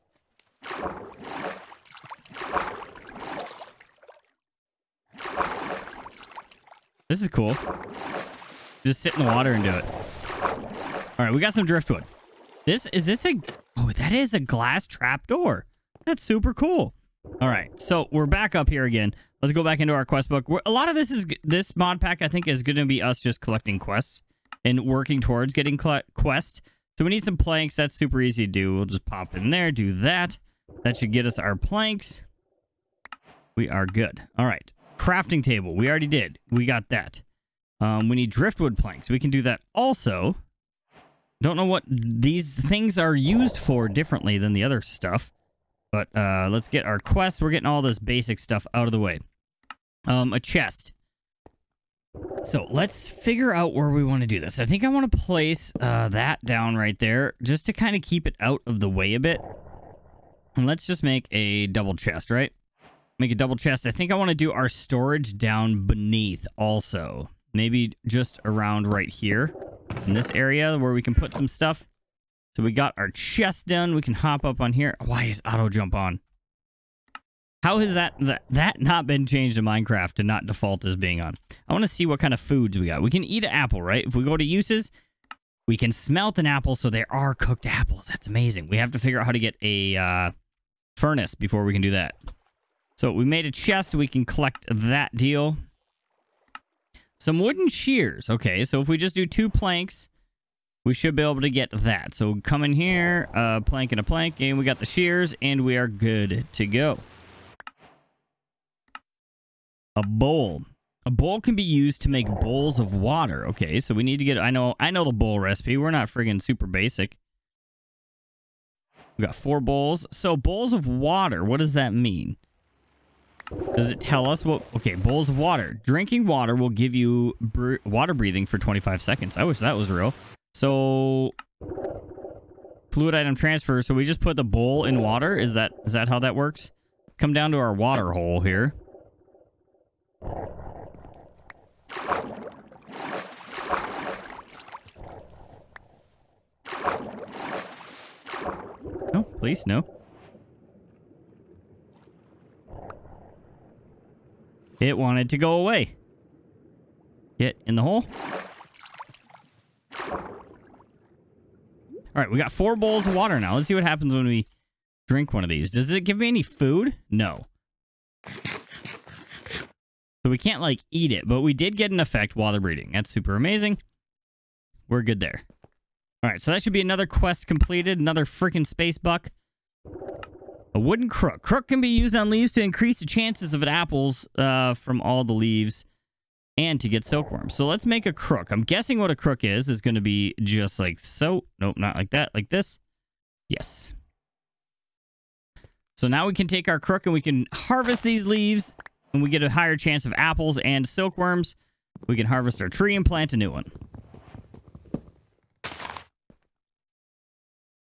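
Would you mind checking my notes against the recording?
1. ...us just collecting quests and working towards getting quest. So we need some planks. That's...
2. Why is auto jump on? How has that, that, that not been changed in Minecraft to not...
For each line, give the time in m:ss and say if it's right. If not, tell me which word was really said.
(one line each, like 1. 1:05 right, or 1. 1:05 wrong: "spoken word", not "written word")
1. 0:23 right
2. 1:15 right.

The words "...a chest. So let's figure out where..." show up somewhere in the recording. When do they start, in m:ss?
0:50.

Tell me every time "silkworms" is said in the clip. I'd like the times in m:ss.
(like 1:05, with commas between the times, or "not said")
3:07, 3:20.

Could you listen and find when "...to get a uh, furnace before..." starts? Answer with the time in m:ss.
1:29.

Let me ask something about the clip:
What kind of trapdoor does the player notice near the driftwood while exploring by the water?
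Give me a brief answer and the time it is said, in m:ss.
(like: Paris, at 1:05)
Glass trap door, at 0:14.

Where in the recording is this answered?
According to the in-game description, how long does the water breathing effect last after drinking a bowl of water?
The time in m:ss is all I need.
2:08.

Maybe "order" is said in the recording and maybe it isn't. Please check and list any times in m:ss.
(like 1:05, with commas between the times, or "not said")
not said.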